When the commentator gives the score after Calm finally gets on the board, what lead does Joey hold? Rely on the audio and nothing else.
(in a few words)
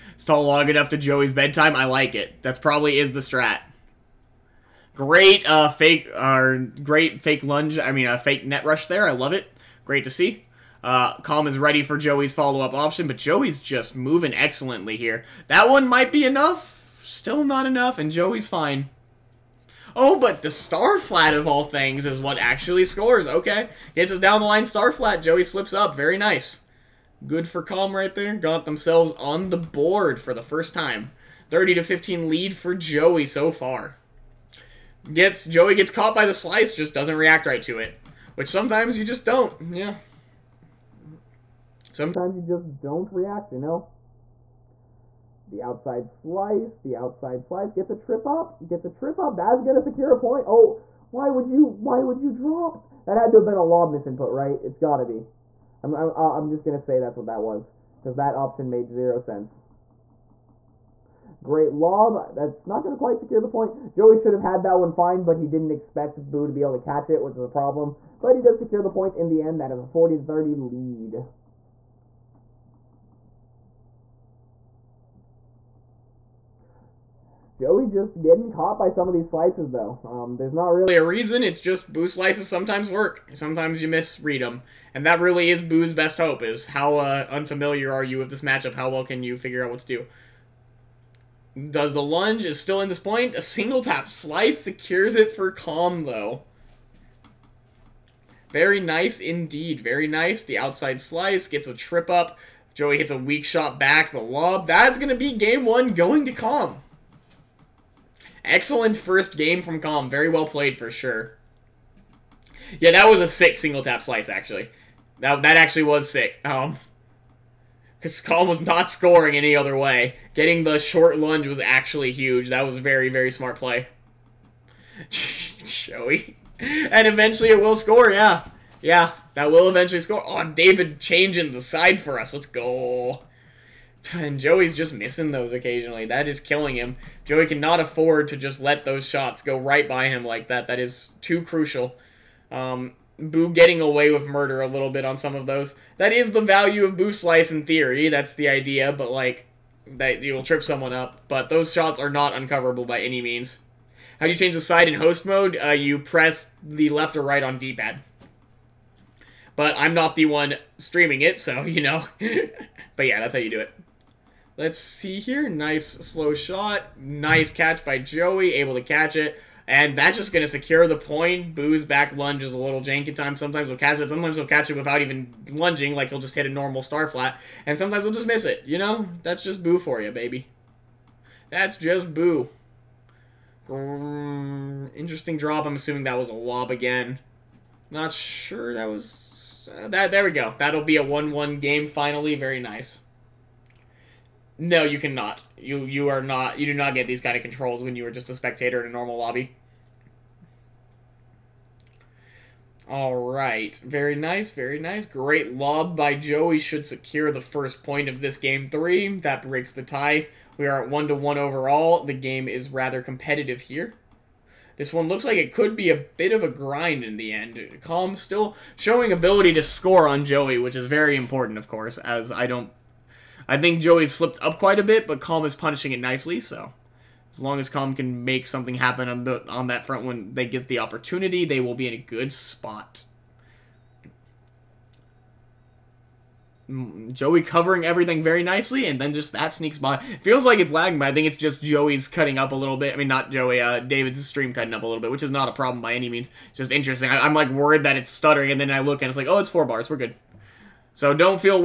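30-15.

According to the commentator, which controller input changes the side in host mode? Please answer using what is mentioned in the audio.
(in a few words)
Left or right on D-pad.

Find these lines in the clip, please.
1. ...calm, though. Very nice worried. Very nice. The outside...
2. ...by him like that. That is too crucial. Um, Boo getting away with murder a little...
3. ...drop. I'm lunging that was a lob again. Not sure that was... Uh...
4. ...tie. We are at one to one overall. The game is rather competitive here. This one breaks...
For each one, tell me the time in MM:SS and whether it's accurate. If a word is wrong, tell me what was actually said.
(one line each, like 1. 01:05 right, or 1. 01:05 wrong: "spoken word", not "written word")
1. 01:35 wrong: "indeed", not "worried"
2. 02:19 right
3. 03:05 wrong: "assuming", not "lunging"
4. 03:29 wrong: "looks", not "breaks".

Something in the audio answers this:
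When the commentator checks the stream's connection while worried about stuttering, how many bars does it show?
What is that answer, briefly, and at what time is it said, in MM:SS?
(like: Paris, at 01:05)
4, at 04:09.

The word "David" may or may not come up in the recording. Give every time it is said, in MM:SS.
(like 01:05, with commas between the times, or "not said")
02:10, 04:03.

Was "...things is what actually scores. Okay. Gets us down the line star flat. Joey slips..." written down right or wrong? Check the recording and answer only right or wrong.
right.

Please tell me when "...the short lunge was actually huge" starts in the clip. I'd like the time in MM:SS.
02:00.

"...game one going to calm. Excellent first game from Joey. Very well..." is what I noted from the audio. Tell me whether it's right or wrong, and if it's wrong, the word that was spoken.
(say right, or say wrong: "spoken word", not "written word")
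wrong: "Calm", not "Joey".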